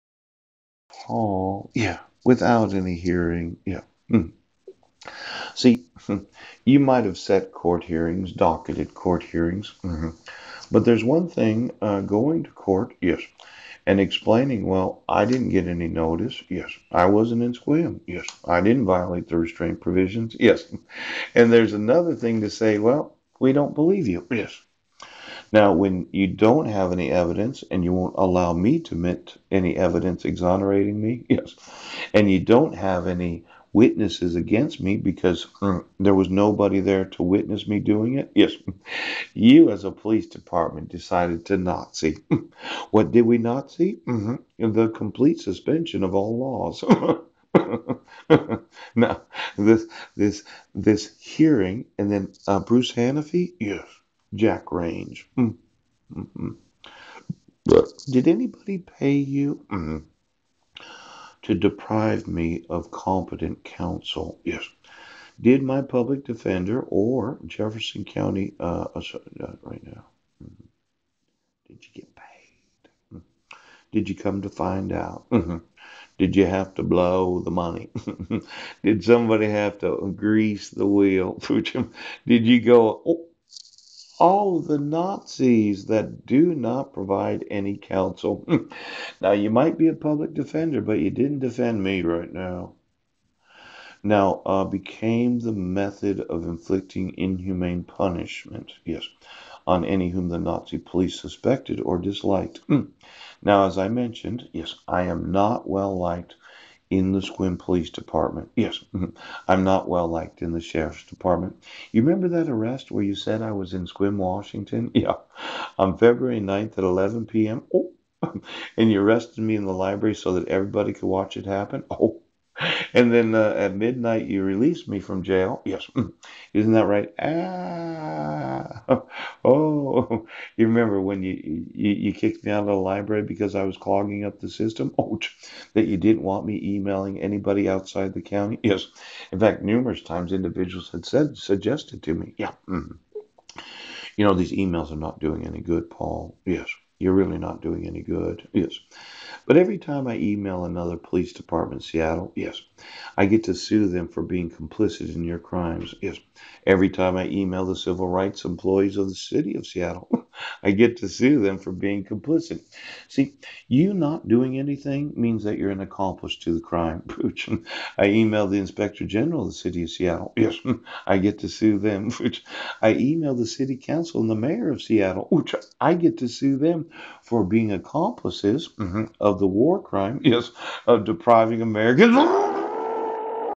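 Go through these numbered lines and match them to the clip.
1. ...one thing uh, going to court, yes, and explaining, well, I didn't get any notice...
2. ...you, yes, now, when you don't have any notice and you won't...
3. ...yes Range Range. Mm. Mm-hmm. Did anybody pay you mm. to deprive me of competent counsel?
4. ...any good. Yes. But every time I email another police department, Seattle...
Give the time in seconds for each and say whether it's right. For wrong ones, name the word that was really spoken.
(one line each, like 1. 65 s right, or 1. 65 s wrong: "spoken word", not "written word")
1. 11 s right
2. 24 s wrong: "evidence", not "notice"
3. 53 s wrong: "Jack", not "Range"
4. 147 s right.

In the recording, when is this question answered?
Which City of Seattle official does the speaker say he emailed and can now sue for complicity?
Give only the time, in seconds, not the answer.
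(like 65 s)
168 s.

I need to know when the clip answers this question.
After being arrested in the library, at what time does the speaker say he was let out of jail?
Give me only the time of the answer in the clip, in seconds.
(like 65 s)
123 s.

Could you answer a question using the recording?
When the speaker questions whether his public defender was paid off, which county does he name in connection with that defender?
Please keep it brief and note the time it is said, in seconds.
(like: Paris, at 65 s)
Jefferson County, at 67 s.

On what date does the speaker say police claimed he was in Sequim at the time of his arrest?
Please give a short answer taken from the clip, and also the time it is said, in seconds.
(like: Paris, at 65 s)
February 9, at 115 s.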